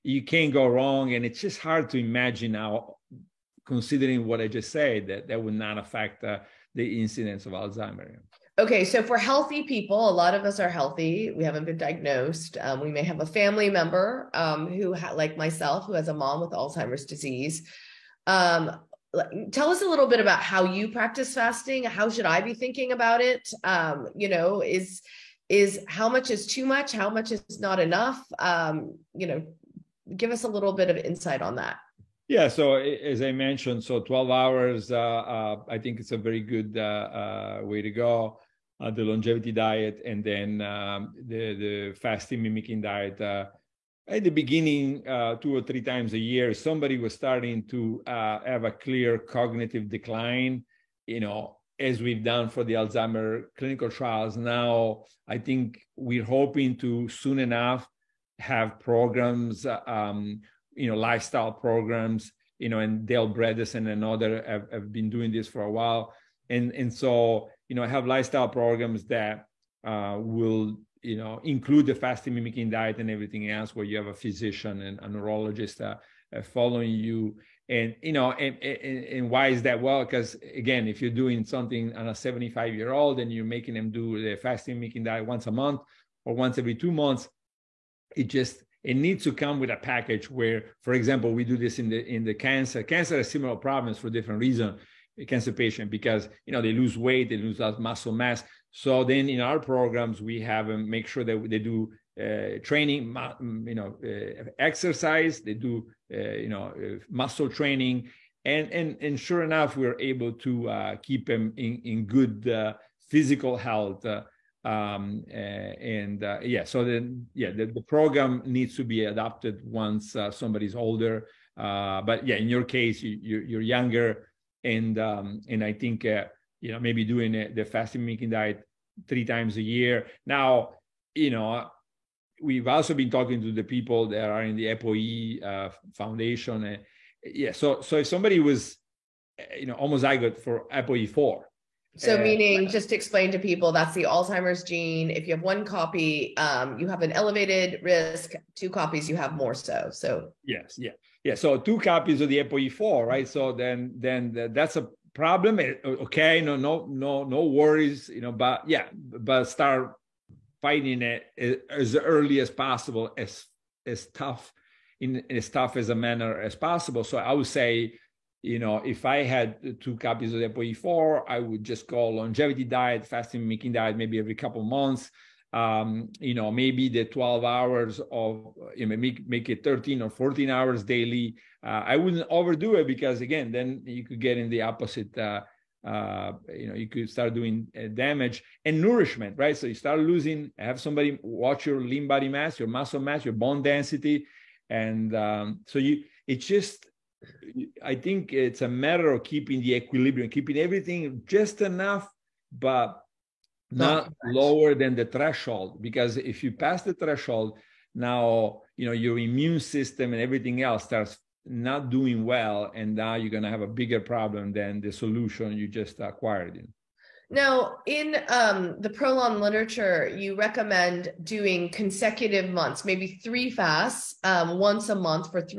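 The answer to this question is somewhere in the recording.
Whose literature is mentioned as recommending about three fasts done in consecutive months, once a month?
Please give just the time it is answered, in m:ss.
3:38.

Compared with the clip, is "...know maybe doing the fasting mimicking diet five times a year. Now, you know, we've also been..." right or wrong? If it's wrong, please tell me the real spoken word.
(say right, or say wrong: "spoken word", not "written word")
wrong: "three", not "five".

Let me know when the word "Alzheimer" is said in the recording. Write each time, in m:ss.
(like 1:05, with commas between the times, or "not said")
0:07, 0:16, 0:52, 2:24.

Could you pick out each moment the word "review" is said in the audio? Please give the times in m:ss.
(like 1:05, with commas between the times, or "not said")
not said.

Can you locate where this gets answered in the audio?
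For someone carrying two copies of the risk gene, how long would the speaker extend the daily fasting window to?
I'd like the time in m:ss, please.
2:59.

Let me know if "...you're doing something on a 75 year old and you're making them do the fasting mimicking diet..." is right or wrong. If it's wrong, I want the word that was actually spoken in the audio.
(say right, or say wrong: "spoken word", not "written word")
right.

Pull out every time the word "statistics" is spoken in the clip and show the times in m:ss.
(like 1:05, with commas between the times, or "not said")
not said.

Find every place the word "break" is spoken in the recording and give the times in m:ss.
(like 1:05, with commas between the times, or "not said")
not said.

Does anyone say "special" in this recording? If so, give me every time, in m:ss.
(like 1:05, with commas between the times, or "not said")
not said.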